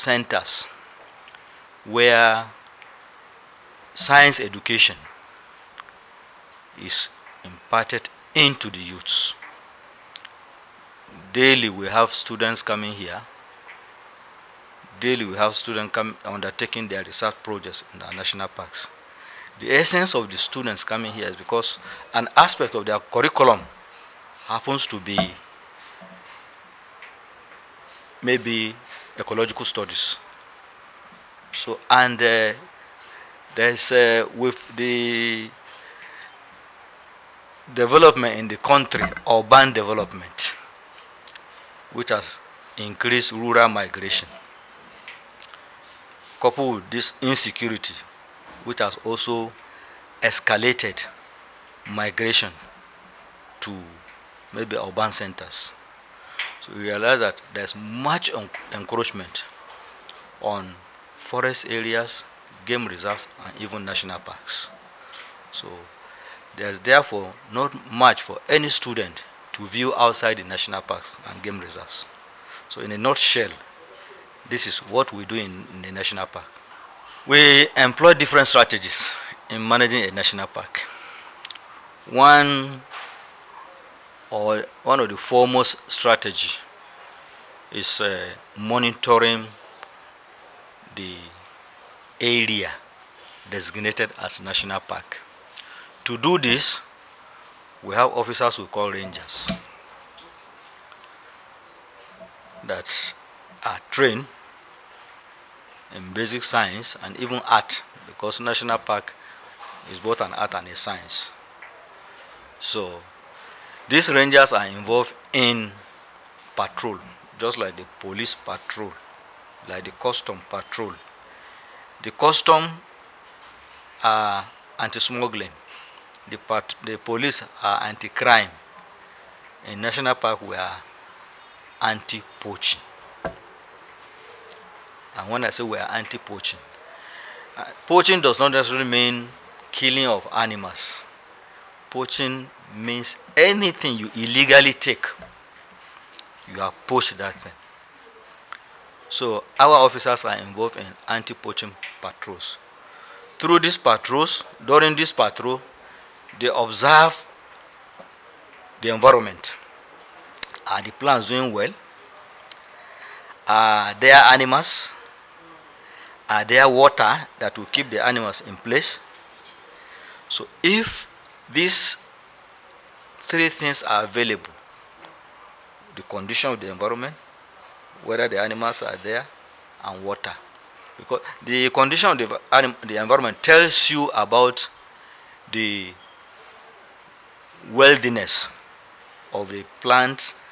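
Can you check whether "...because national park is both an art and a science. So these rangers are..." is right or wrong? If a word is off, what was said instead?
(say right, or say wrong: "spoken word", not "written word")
right.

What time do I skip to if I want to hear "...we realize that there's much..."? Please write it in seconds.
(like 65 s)
56 s.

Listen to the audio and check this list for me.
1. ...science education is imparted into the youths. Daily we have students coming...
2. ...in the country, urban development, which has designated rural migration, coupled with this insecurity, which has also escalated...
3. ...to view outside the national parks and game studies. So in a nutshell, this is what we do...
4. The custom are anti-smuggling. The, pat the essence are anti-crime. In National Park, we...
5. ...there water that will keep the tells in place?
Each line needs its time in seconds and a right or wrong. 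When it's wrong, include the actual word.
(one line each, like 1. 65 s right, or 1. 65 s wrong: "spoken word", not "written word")
1. 3 s right
2. 38 s wrong: "increased", not "designated"
3. 69 s wrong: "reserves", not "studies"
4. 122 s wrong: "police", not "essence"
5. 166 s wrong: "animals", not "tells".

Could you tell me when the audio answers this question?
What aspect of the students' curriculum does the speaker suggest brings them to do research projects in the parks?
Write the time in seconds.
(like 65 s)
29 s.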